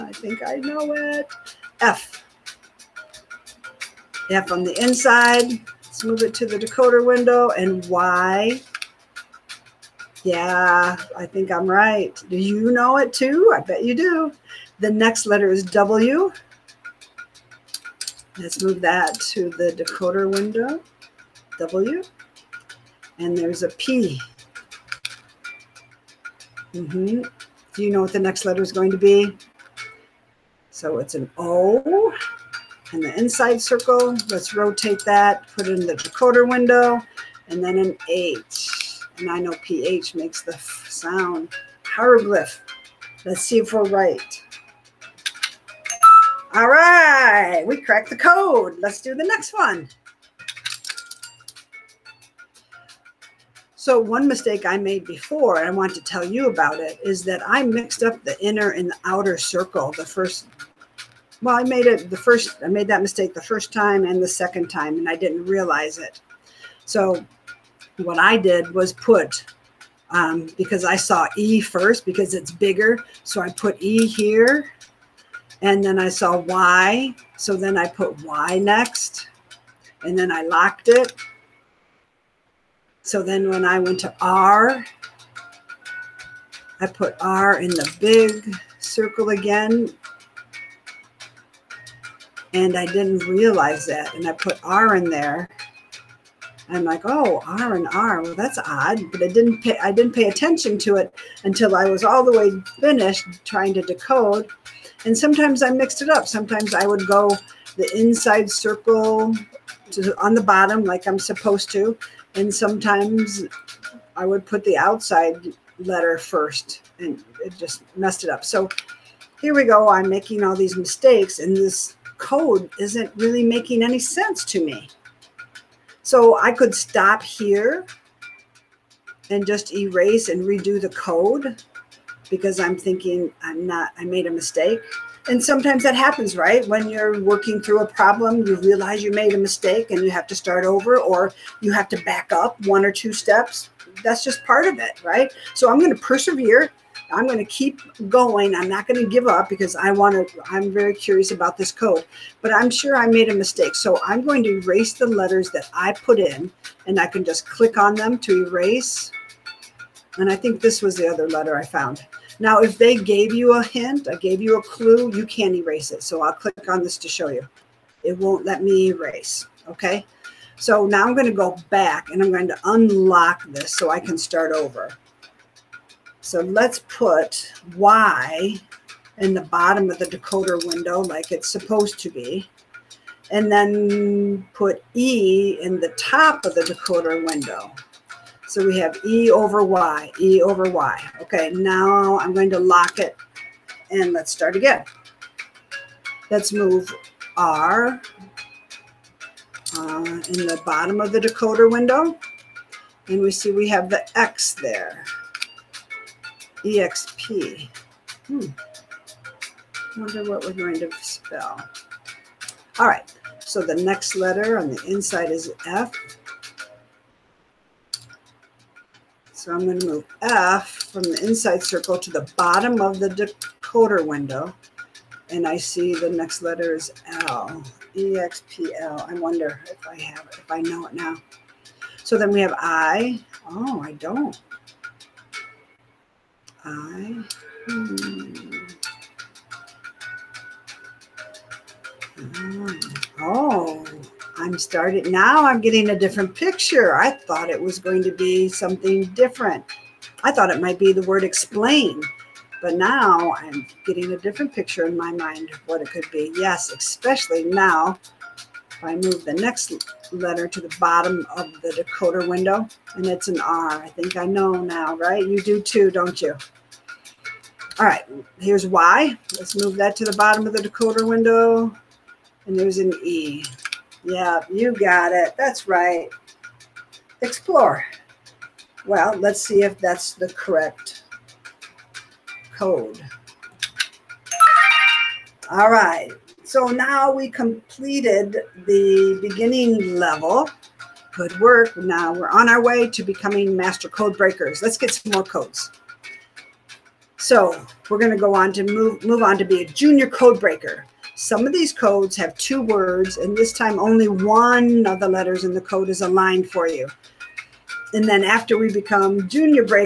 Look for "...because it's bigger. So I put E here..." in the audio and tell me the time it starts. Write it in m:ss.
1:12.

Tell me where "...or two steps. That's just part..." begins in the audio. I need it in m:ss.
2:22.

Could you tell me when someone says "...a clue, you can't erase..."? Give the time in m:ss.
2:44.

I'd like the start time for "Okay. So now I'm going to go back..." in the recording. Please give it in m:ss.
2:49.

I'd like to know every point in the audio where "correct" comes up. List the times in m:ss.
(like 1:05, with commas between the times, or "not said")
4:40.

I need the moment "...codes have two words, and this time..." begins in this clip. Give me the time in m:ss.
5:01.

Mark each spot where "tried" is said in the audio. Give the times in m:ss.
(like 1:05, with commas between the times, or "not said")
not said.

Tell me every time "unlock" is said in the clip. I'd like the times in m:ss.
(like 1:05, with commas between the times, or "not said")
2:52.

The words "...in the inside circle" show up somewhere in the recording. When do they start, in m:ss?
0:32.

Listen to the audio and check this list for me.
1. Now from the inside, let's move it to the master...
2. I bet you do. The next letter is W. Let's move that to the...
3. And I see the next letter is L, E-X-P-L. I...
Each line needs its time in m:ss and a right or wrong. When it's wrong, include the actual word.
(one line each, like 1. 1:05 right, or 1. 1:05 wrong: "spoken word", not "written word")
1. 0:04 wrong: "decoder", not "master"
2. 0:13 right
3. 3:45 right.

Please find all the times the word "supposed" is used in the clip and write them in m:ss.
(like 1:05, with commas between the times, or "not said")
1:51, 3:01.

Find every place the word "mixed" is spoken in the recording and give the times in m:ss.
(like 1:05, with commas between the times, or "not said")
0:57, 1:45.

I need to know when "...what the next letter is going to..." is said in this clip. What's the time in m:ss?
0:28.